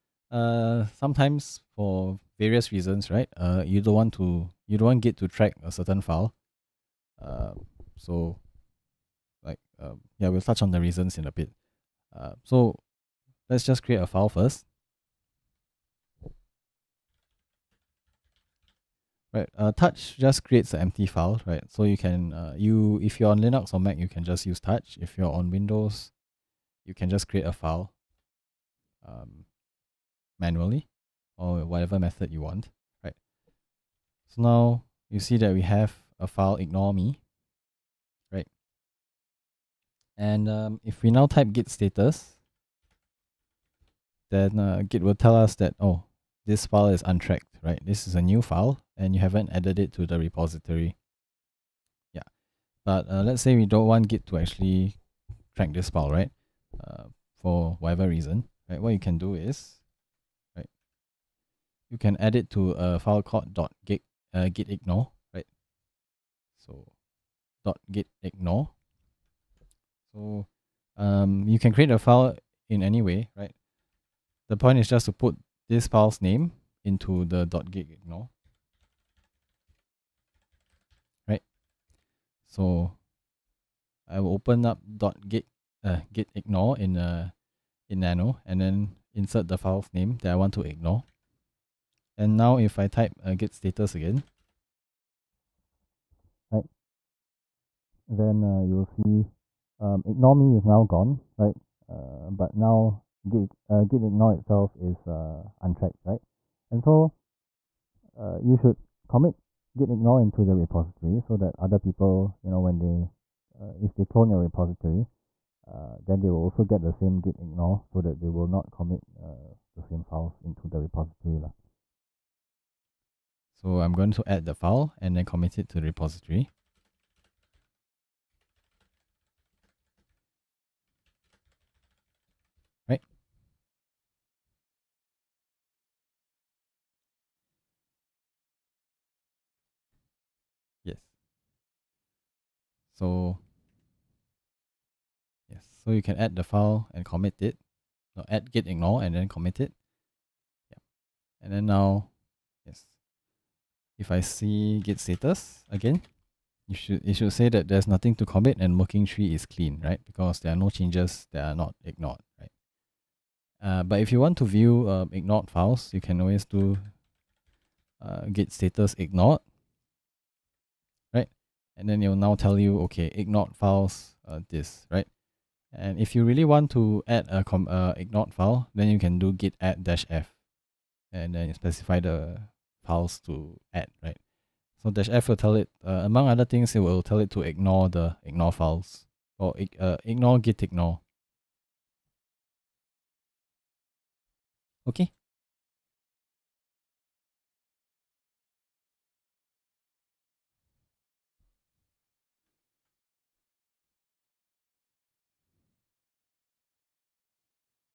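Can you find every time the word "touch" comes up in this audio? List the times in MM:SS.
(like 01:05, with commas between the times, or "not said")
00:10, 00:19, 00:24.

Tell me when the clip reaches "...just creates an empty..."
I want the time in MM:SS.
00:20.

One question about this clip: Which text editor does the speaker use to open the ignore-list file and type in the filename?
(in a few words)
nano.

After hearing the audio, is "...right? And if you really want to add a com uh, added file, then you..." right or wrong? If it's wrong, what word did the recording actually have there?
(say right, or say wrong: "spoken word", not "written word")
wrong: "ignored", not "added".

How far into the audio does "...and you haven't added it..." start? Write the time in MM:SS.
00:48.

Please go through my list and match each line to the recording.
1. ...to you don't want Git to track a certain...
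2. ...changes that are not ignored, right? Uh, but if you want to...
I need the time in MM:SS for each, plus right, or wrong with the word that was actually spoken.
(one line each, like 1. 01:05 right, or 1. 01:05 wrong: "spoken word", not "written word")
1. 00:04 right
2. 02:40 right.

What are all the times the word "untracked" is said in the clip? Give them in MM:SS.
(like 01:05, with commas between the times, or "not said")
00:47, 01:45.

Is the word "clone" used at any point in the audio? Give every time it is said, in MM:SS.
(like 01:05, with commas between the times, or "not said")
01:54.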